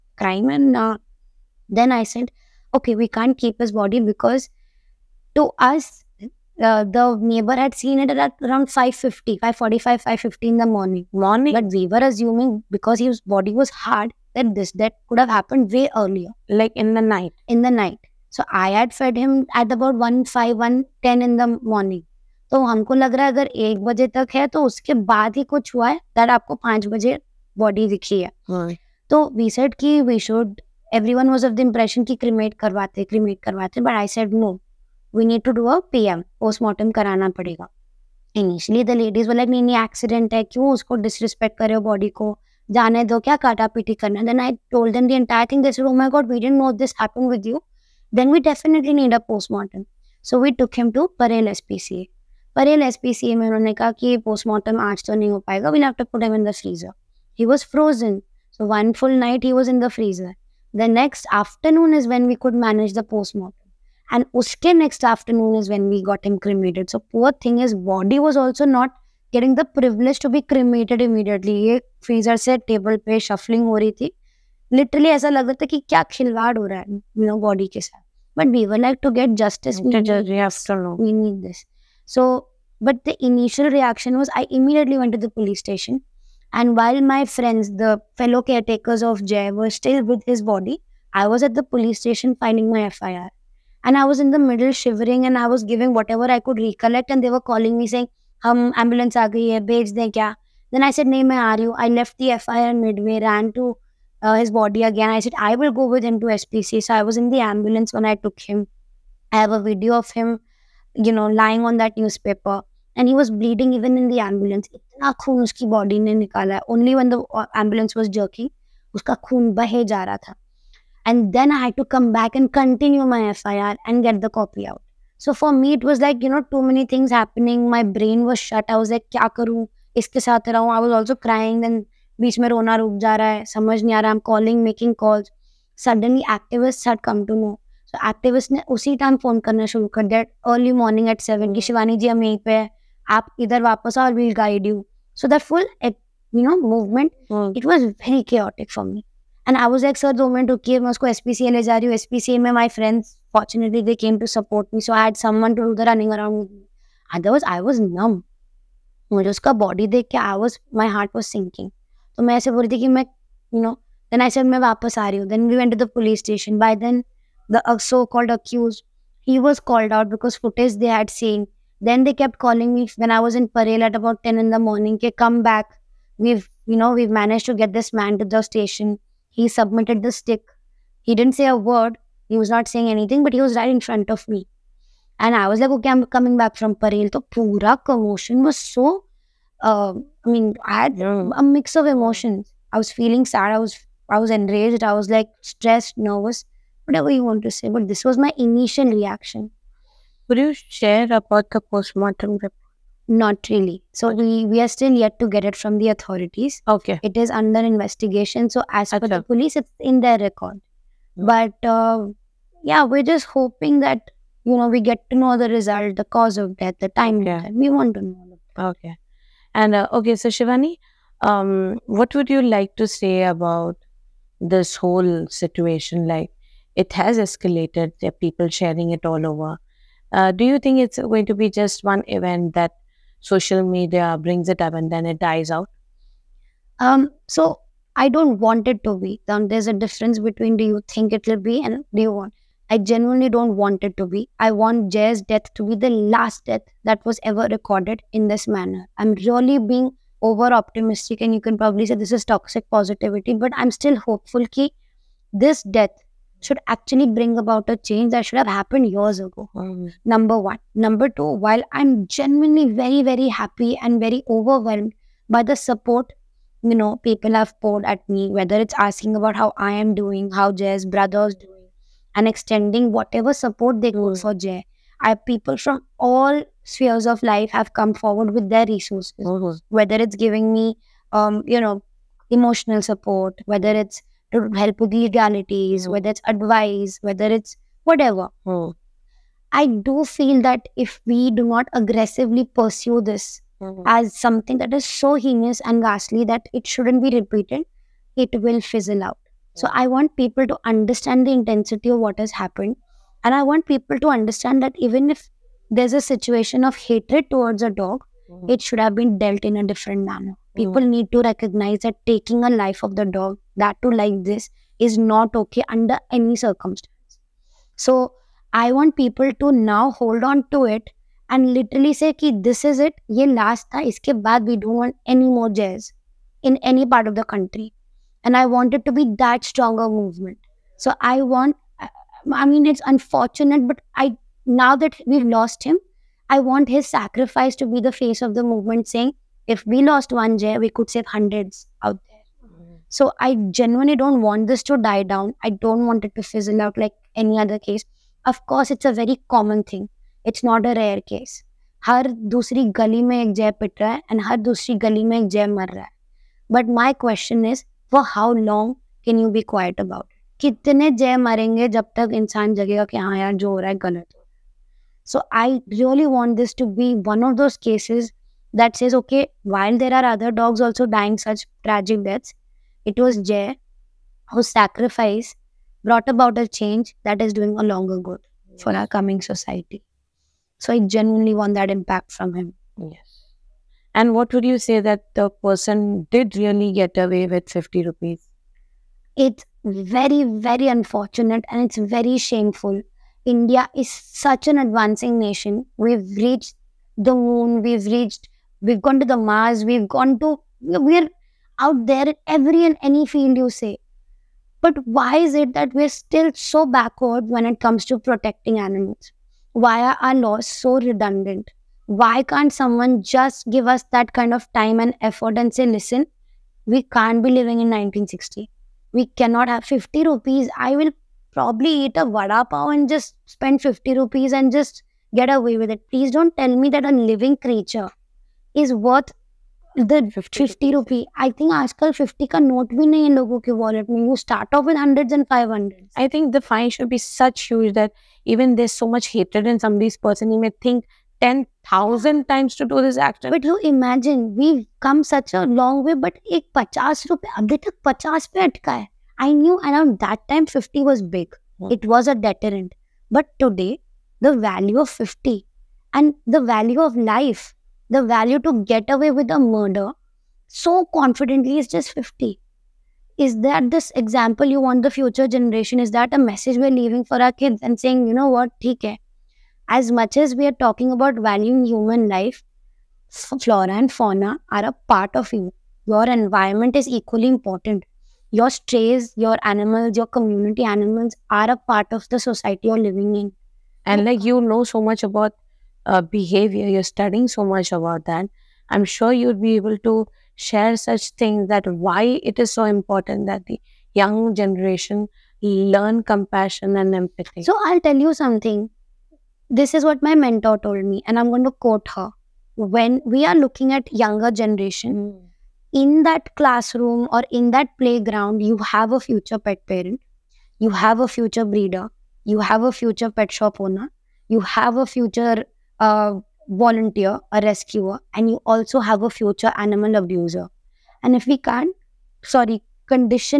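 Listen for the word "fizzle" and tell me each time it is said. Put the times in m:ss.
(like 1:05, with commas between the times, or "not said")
4:58, 5:46.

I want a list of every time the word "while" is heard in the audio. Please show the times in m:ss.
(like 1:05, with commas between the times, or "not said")
1:26, 4:21, 6:09.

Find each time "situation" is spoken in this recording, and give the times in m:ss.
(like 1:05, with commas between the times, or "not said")
3:45, 5:06.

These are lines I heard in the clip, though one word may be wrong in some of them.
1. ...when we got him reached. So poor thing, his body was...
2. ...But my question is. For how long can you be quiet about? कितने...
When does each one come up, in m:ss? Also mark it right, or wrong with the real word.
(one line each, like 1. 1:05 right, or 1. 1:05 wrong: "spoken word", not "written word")
1. 1:05 wrong: "cremated", not "reached"
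2. 5:56 right.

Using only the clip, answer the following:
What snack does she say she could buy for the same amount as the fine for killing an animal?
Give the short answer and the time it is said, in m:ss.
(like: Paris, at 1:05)
Vada pav, at 7:02.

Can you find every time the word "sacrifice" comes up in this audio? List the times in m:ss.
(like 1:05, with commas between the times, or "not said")
5:36, 6:14.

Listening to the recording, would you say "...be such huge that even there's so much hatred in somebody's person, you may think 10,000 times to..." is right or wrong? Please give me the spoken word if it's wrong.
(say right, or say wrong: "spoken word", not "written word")
right.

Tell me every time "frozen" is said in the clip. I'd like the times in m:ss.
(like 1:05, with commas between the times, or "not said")
0:57.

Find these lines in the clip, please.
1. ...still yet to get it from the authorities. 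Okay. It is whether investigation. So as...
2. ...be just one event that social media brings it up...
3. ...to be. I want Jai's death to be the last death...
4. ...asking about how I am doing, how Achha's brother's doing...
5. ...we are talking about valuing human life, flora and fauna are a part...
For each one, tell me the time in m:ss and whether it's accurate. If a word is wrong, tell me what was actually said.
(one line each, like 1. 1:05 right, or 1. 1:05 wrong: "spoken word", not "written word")
1. 3:24 wrong: "under", not "whether"
2. 3:51 right
3. 4:03 right
4. 4:28 wrong: "Jai", not "Achha"
5. 7:50 right.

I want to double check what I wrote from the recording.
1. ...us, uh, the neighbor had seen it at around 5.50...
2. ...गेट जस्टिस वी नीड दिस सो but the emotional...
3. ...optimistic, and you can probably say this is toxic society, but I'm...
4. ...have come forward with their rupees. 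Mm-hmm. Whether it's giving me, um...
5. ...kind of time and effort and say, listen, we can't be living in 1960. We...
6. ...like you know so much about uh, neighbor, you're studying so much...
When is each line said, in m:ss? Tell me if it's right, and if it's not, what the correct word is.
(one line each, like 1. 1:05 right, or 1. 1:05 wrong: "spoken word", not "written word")
1. 0:05 right
2. 1:19 wrong: "initial", not "emotional"
3. 4:10 wrong: "positivity", not "society"
4. 4:37 wrong: "resources", not "rupees"
5. 6:54 right
6. 8:04 wrong: "behavior", not "neighbor".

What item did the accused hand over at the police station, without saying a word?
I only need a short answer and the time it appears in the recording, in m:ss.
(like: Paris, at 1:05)
The stick, at 2:59.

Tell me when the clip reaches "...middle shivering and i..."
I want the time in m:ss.
1:34.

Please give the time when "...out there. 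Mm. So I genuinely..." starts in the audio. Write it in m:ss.
5:41.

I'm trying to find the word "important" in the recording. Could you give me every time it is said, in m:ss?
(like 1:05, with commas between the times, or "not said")
7:57, 8:12.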